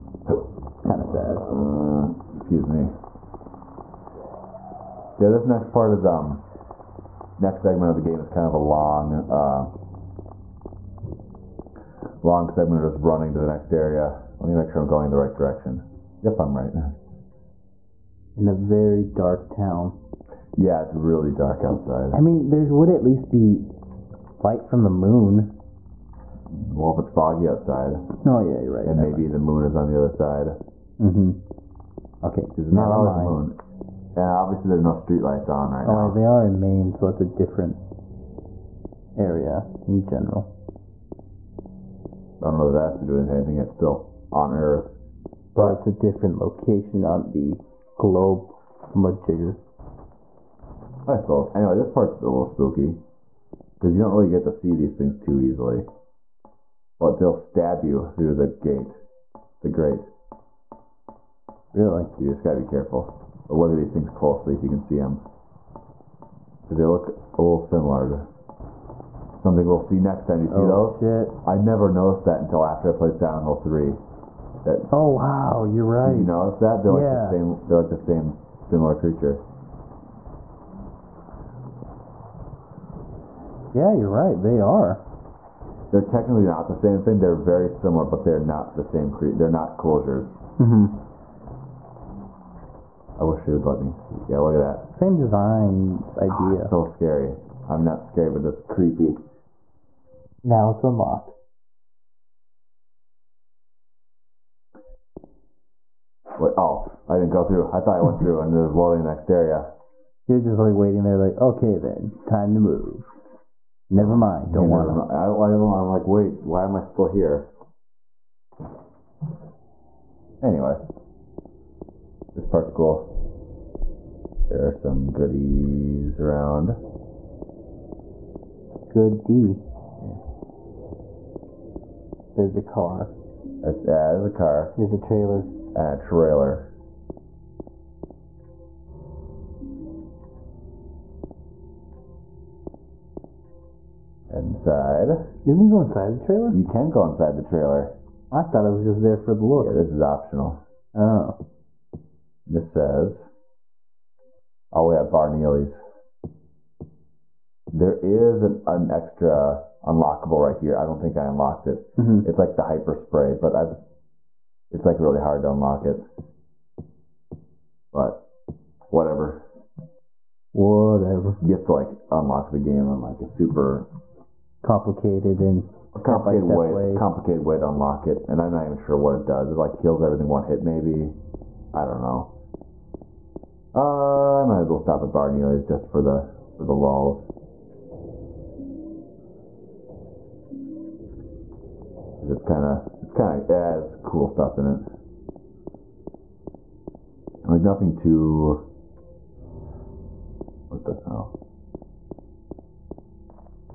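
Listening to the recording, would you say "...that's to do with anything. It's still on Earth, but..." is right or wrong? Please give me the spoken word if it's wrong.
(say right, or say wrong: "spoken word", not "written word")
right.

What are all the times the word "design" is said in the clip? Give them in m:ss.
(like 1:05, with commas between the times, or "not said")
1:35.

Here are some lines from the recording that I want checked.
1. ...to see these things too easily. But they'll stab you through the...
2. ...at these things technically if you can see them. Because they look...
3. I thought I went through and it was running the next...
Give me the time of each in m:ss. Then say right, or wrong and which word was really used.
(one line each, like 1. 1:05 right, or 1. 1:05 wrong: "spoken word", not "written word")
1. 0:54 right
2. 1:03 wrong: "closely", not "technically"
3. 1:47 wrong: "loading", not "running".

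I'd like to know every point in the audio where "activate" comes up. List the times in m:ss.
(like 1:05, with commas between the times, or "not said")
not said.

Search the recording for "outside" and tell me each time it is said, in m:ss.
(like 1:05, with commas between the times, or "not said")
0:21, 0:27.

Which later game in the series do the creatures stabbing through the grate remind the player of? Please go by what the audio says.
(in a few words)
Silent Hill 3.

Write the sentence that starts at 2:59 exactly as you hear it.
It like kills everything one hit, maybe.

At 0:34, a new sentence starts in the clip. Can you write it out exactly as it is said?
And obviously, there are no streetlights on right oh, now.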